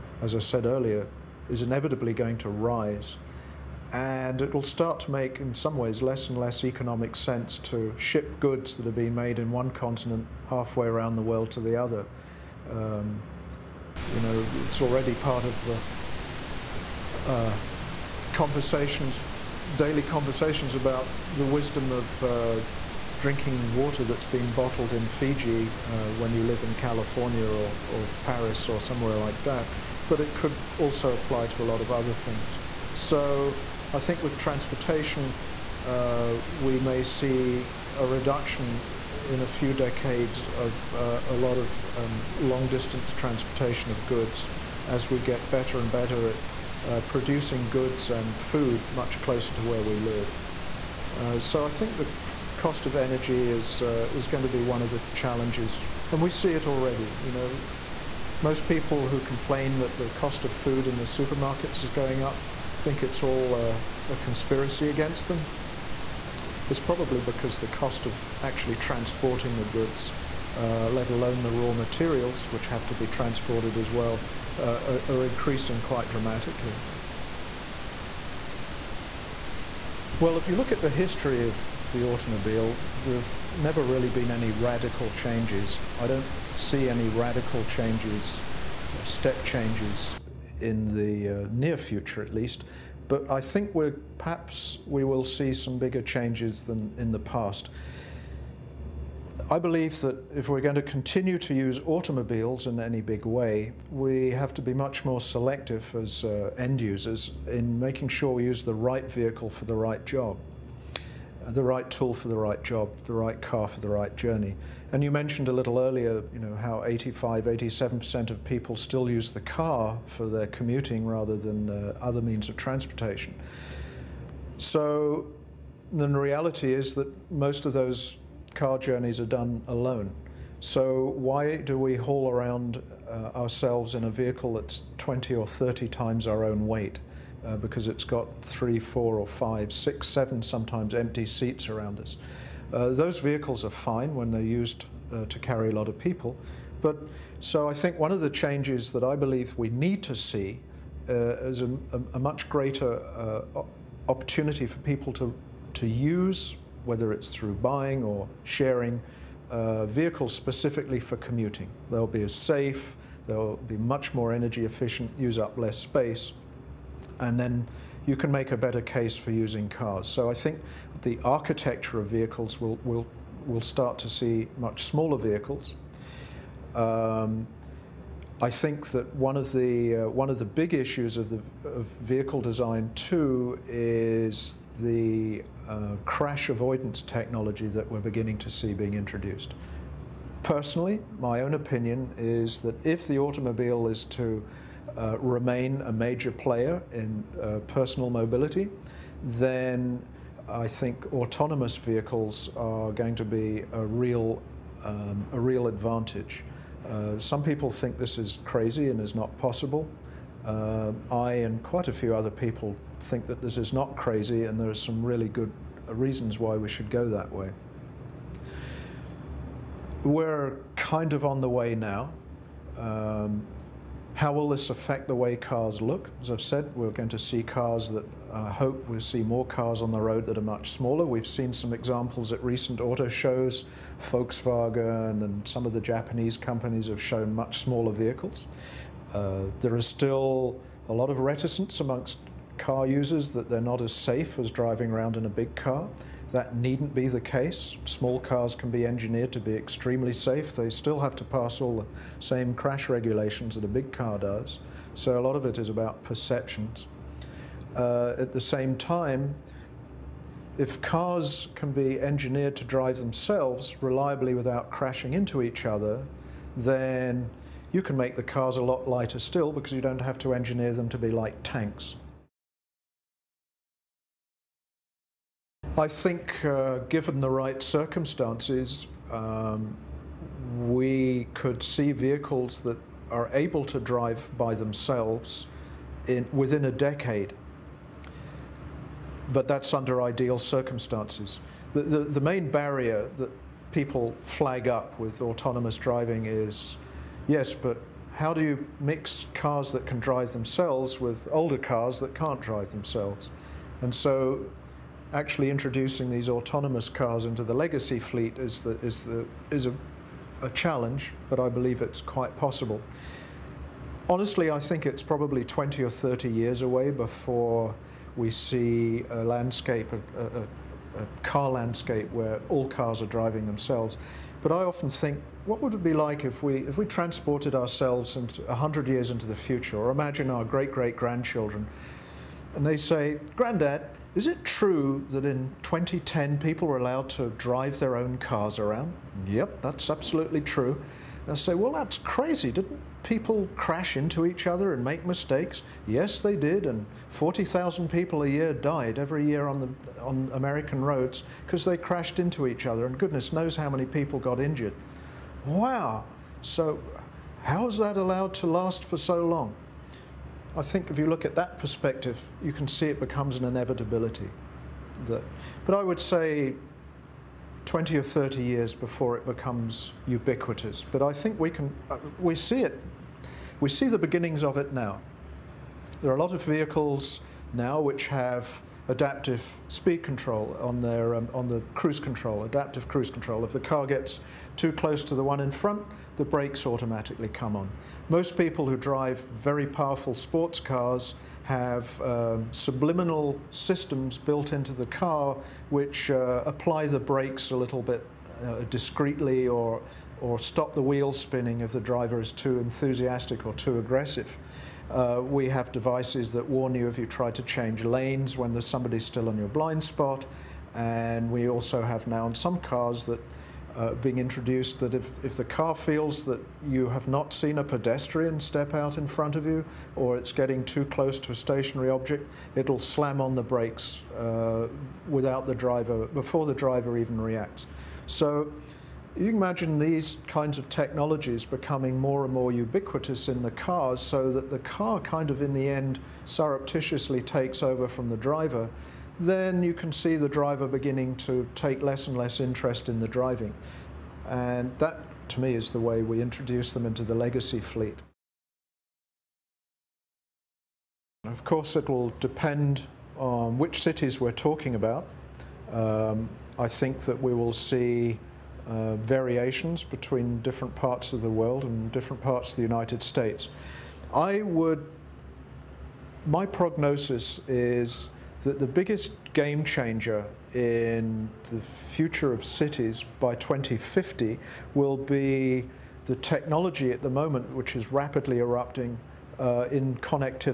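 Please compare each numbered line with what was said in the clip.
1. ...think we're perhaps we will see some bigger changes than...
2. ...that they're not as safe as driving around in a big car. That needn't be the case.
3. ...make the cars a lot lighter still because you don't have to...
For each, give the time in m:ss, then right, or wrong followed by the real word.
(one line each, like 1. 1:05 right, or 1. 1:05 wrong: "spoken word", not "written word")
1. 1:33 right
2. 4:03 right
3. 4:27 right.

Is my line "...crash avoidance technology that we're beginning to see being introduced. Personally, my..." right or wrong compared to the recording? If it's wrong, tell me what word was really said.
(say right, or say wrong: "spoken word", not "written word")
right.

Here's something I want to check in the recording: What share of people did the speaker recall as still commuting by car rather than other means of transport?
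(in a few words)
85, 87%.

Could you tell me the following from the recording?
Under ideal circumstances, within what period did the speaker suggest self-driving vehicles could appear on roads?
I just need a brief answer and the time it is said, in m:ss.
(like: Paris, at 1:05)
within a decade, at 4:46.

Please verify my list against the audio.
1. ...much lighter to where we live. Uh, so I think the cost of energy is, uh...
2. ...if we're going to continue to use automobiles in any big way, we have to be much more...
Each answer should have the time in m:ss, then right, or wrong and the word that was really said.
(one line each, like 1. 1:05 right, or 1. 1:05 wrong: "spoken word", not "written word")
1. 0:48 wrong: "closer", not "lighter"
2. 1:40 right.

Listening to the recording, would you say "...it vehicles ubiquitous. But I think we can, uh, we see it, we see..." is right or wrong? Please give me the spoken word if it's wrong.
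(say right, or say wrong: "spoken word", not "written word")
wrong: "becomes", not "vehicles".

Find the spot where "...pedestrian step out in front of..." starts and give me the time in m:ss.
6:57.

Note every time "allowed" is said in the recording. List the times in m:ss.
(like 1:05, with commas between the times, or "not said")
5:36, 5:57.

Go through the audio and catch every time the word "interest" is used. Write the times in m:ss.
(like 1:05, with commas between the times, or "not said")
7:22.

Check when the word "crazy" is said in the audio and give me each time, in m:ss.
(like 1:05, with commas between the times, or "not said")
3:28, 3:33, 5:41.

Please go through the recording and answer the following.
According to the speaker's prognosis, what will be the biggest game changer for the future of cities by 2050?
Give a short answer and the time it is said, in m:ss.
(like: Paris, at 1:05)
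connectivity, at 7:59.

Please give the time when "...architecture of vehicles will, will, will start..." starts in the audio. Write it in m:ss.
2:51.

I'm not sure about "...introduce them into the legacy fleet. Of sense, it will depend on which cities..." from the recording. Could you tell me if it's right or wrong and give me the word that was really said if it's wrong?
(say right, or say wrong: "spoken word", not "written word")
wrong: "course", not "sense".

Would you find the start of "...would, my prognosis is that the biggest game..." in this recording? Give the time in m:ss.
7:44.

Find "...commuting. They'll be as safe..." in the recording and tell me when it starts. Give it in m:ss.
2:41.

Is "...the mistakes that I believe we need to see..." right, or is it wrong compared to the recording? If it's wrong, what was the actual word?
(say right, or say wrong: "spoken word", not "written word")
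wrong: "changes", not "mistakes".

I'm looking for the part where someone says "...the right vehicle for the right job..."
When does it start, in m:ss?
1:48.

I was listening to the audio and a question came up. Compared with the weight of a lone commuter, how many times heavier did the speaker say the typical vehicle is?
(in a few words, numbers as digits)
20 or 30 times.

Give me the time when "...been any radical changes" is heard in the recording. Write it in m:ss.
1:24.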